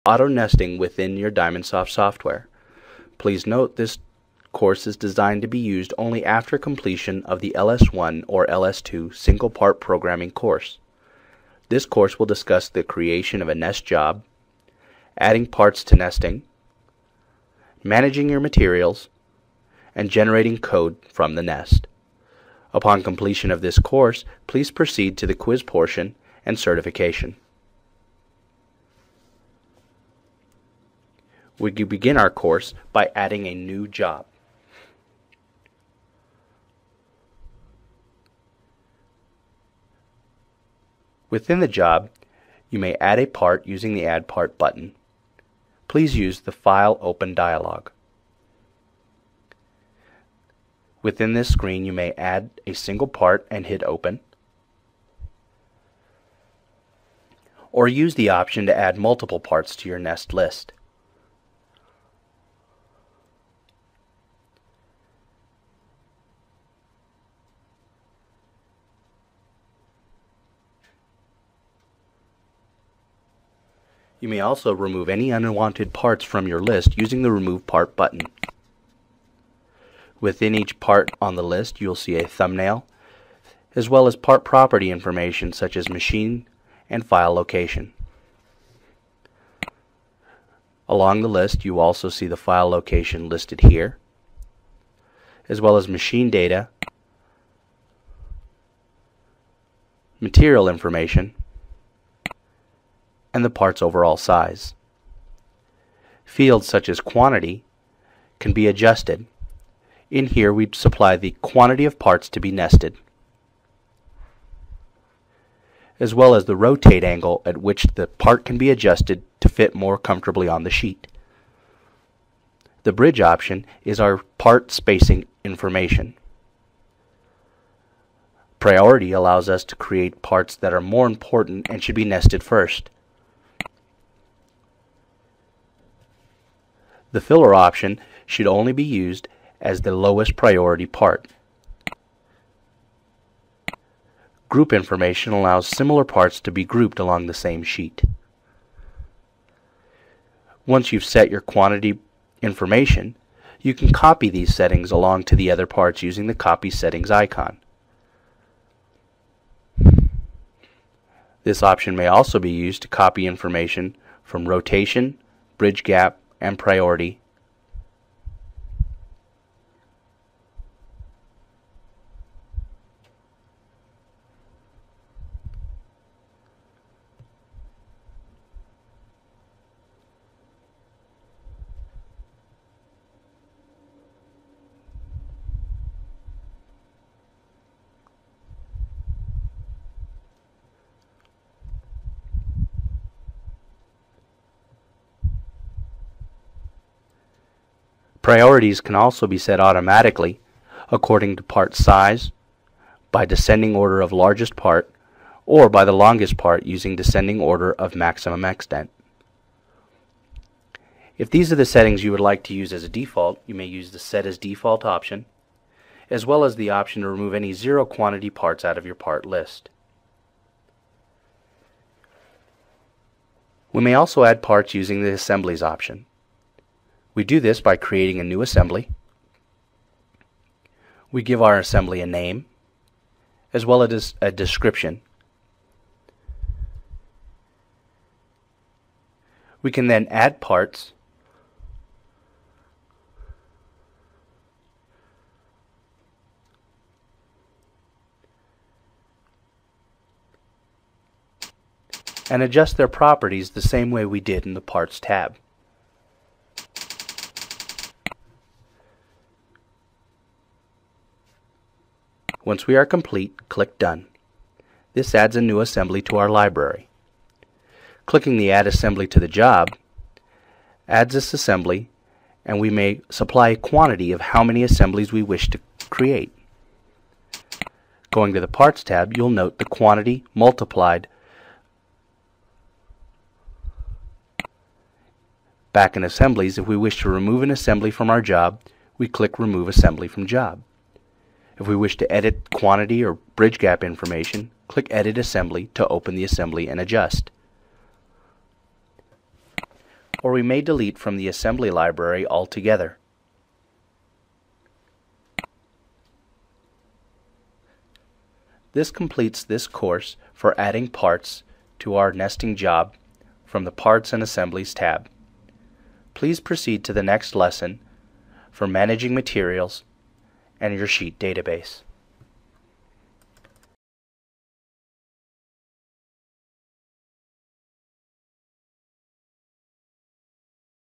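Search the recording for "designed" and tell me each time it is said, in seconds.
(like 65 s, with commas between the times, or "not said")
4 s.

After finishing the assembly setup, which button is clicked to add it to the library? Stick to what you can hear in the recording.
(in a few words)
Done.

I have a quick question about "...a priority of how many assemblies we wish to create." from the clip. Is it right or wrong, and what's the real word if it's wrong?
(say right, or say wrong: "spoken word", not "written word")
wrong: "quantity", not "priority".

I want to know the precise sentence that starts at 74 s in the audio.
You may also remove any unwanted parts from your list using the Remove Part button.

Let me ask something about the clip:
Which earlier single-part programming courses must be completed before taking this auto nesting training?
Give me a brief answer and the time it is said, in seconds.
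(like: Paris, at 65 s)
LS1 or LS2, at 7 s.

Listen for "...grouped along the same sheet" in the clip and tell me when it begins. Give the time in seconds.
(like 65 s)
146 s.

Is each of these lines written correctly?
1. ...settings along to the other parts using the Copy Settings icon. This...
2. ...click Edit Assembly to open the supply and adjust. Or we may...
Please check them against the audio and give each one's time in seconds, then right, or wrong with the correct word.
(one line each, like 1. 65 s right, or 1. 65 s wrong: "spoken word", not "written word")
1. 154 s right
2. 294 s wrong: "assembly", not "supply".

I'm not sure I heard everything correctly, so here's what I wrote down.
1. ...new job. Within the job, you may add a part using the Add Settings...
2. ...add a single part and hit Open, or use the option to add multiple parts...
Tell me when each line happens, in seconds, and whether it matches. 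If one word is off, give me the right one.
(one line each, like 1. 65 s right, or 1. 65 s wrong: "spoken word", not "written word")
1. 33 s wrong: "Part", not "Settings"
2. 52 s right.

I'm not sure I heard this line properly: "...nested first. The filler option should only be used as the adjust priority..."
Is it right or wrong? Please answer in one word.
wrong.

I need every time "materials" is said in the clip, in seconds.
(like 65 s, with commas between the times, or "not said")
18 s, 100 s, 319 s.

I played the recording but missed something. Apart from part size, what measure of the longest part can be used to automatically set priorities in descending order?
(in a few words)
Maximum extent.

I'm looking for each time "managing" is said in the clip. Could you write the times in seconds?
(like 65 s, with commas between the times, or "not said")
17 s, 318 s.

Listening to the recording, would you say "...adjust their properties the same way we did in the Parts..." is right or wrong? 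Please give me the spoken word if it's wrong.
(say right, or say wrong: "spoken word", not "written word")
right.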